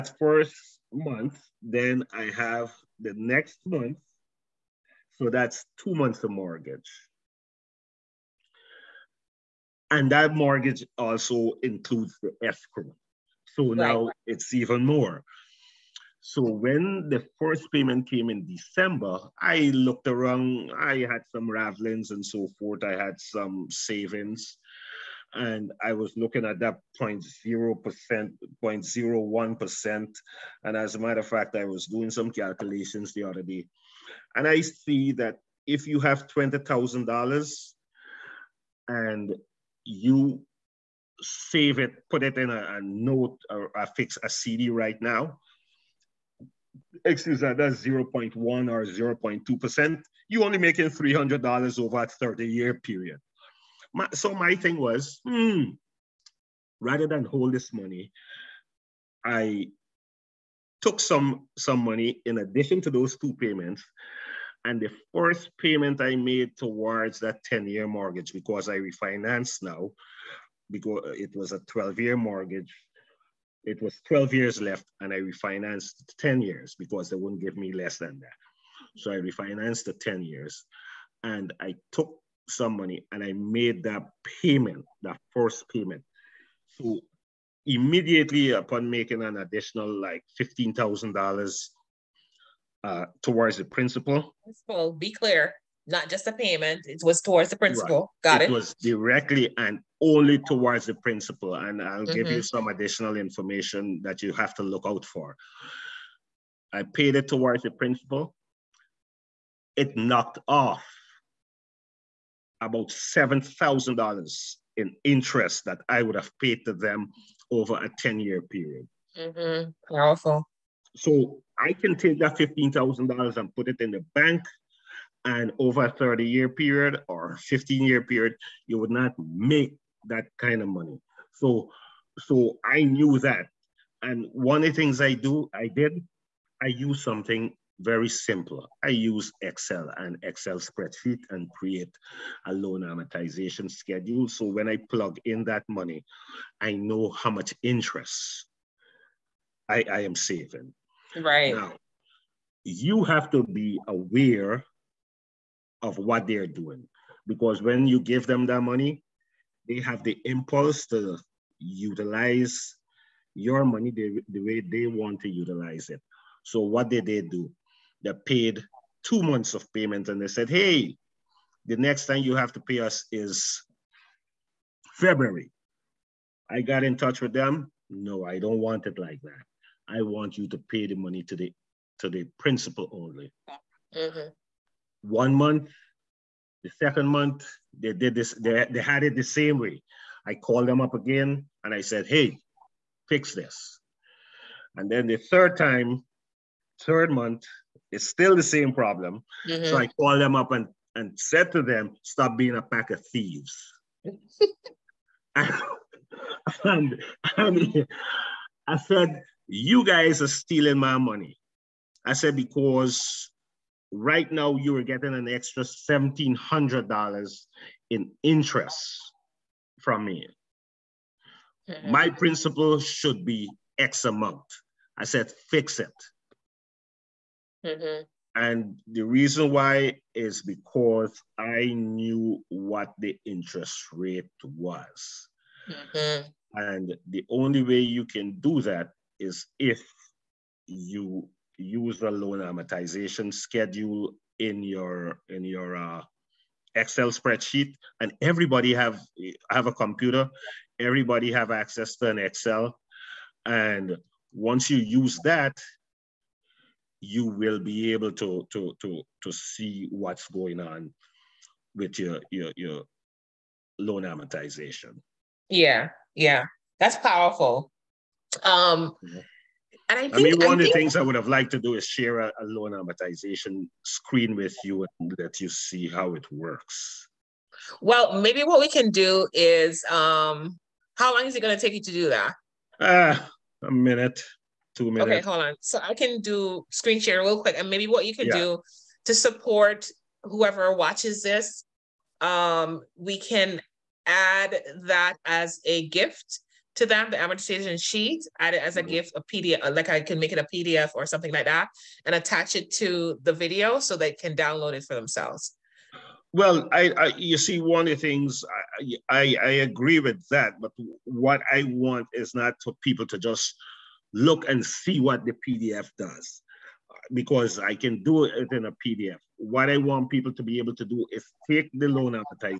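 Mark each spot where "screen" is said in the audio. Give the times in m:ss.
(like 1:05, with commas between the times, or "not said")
4:33, 4:46.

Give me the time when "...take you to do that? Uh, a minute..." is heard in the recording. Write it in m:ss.
4:41.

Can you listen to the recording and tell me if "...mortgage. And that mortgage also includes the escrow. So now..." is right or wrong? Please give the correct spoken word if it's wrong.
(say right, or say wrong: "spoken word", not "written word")
right.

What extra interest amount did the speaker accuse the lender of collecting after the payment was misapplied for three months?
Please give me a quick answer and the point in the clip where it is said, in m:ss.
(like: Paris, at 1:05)
$1,700, at 3:35.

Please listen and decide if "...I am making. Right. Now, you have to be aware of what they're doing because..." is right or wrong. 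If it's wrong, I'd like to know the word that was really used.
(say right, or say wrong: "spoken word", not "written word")
wrong: "saving", not "making".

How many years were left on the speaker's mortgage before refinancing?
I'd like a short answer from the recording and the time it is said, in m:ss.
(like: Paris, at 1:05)
12 years, at 1:11.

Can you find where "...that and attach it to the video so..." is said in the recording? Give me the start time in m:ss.
5:01.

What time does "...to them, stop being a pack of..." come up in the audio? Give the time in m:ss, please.
3:21.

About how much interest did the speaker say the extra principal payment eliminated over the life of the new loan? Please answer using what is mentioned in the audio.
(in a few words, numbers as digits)
$7,000.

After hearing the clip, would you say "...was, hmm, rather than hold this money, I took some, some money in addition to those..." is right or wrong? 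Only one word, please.
right.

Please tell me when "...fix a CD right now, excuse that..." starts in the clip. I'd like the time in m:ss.
0:43.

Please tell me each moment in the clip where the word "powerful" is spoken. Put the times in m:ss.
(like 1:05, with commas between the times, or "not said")
1:59, 4:26.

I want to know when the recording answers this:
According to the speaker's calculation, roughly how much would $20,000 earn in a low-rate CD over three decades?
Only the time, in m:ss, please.
0:50.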